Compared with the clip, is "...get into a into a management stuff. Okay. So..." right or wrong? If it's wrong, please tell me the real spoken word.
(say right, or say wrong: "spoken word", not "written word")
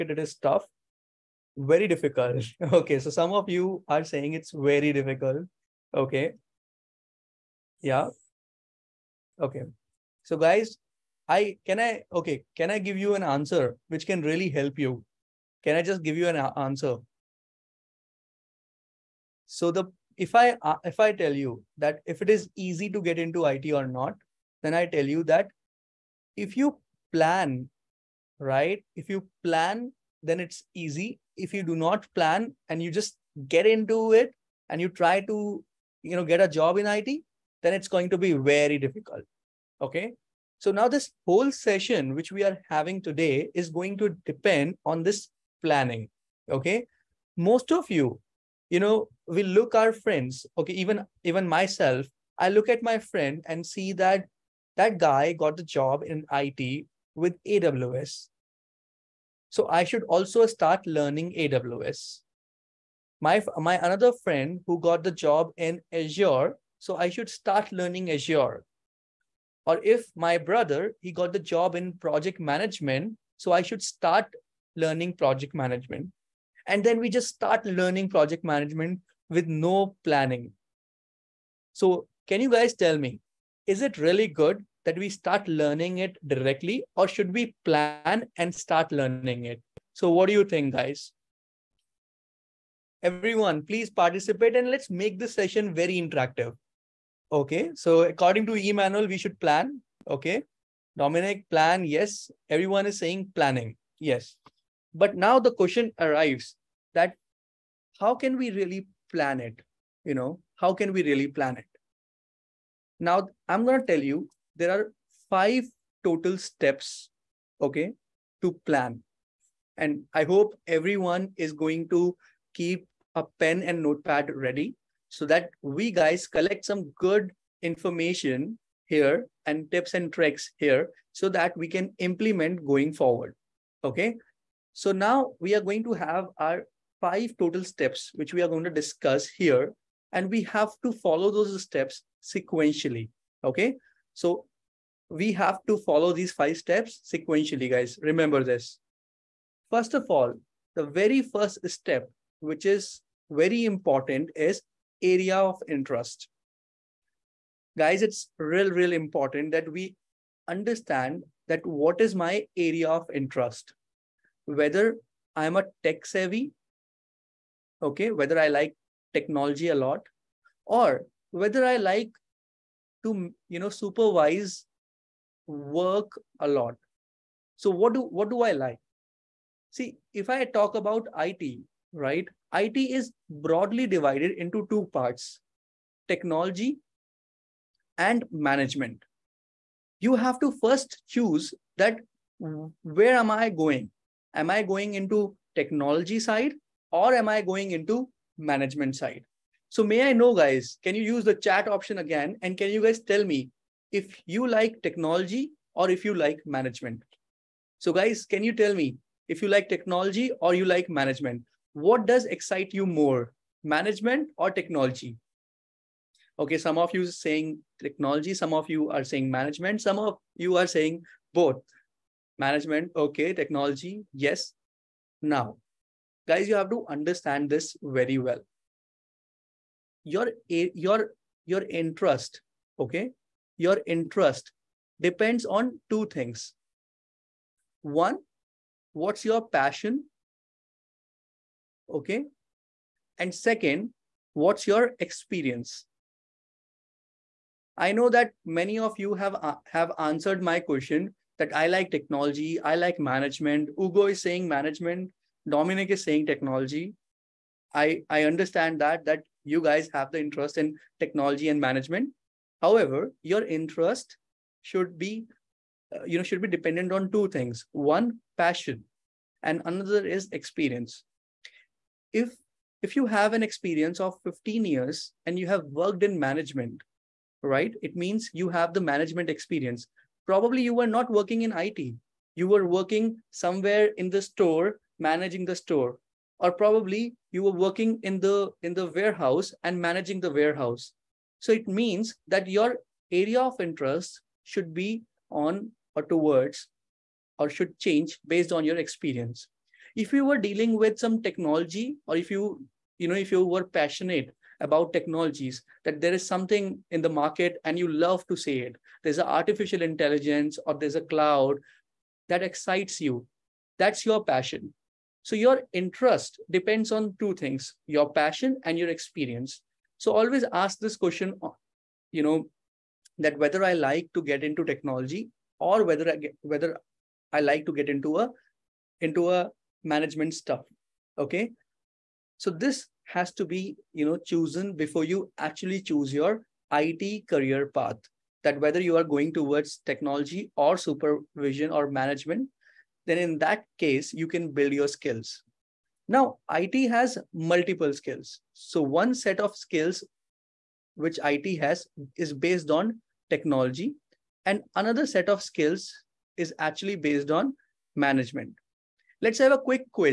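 right.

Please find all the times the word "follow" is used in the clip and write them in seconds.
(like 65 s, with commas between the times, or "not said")
140 s, 145 s.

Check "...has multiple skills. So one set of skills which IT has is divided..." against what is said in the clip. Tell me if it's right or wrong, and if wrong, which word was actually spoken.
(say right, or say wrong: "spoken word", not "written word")
wrong: "based", not "divided".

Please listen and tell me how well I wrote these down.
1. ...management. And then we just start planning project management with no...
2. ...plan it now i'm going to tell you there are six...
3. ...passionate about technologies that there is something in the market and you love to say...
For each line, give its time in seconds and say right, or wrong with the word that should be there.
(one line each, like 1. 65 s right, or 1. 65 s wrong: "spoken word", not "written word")
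1. 75 s wrong: "learning", not "planning"
2. 111 s wrong: "five", not "six"
3. 303 s right.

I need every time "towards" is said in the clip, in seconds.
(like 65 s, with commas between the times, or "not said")
296 s, 339 s.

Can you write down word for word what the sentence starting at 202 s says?
And can you guys tell me if you like technology or if you like management?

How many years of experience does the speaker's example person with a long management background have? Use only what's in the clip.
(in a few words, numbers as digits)
15.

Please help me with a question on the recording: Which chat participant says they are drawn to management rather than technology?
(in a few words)
Ugo.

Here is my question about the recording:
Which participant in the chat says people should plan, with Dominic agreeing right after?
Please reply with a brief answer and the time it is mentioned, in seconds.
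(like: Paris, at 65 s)
Emmanuel, at 98 s.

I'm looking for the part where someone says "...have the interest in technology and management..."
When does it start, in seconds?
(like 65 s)
259 s.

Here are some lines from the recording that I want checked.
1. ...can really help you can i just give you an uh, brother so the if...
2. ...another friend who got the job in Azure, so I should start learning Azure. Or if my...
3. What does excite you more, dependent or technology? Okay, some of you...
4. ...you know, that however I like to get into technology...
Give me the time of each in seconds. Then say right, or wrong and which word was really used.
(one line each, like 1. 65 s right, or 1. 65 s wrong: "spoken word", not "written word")
1. 14 s wrong: "answer", not "brother"
2. 63 s right
3. 211 s wrong: "management", not "dependent"
4. 322 s wrong: "whether", not "however".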